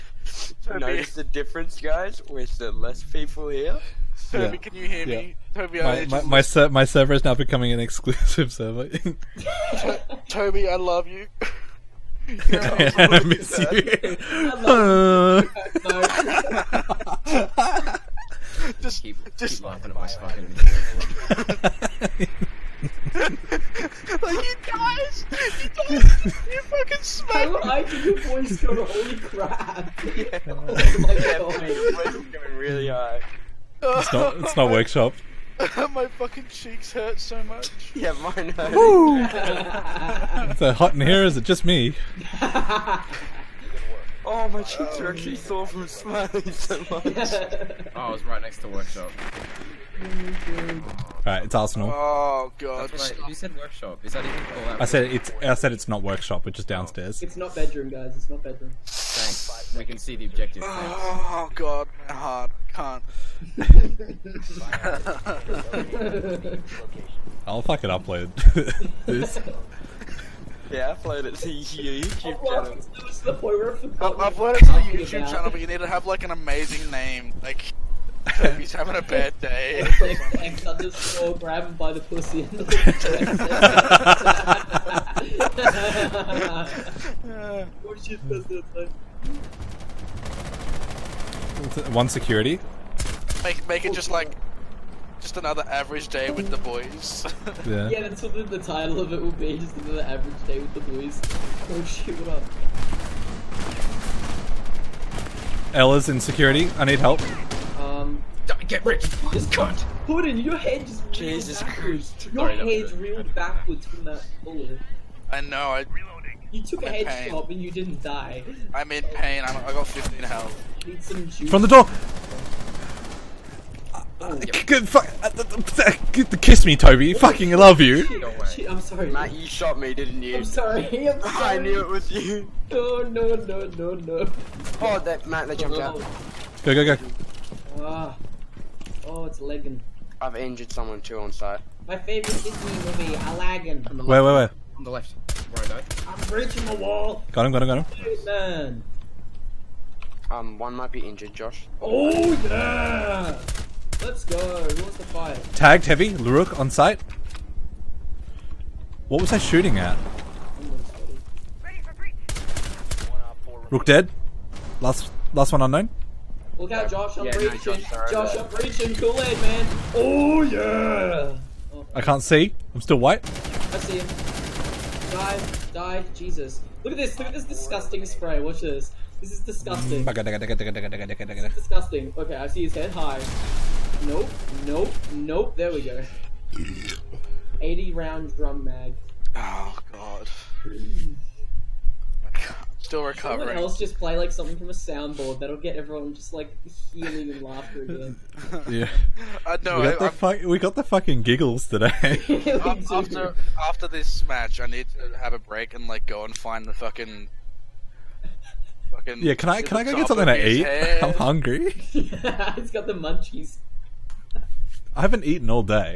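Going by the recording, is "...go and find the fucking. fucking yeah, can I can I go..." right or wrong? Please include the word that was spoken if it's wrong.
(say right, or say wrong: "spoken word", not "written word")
right.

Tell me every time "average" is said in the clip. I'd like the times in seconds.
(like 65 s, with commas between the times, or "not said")
95 s, 100 s.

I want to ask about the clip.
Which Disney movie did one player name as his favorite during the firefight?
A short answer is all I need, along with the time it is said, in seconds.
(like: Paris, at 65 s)
Aladdin, at 143 s.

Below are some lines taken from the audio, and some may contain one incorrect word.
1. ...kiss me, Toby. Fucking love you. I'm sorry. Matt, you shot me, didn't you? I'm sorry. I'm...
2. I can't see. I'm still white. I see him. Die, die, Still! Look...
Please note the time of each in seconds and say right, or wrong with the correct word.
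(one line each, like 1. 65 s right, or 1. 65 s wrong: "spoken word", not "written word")
1. 126 s right
2. 171 s wrong: "Jesus", not "Still".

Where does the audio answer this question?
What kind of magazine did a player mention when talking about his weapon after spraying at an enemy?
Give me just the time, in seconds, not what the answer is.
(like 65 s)
187 s.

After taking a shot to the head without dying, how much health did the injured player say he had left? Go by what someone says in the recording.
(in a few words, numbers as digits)
15.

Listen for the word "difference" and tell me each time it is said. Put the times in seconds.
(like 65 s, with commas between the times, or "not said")
1 s.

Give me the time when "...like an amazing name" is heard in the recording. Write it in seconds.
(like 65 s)
76 s.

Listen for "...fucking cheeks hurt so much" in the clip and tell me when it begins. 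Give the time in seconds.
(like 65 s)
36 s.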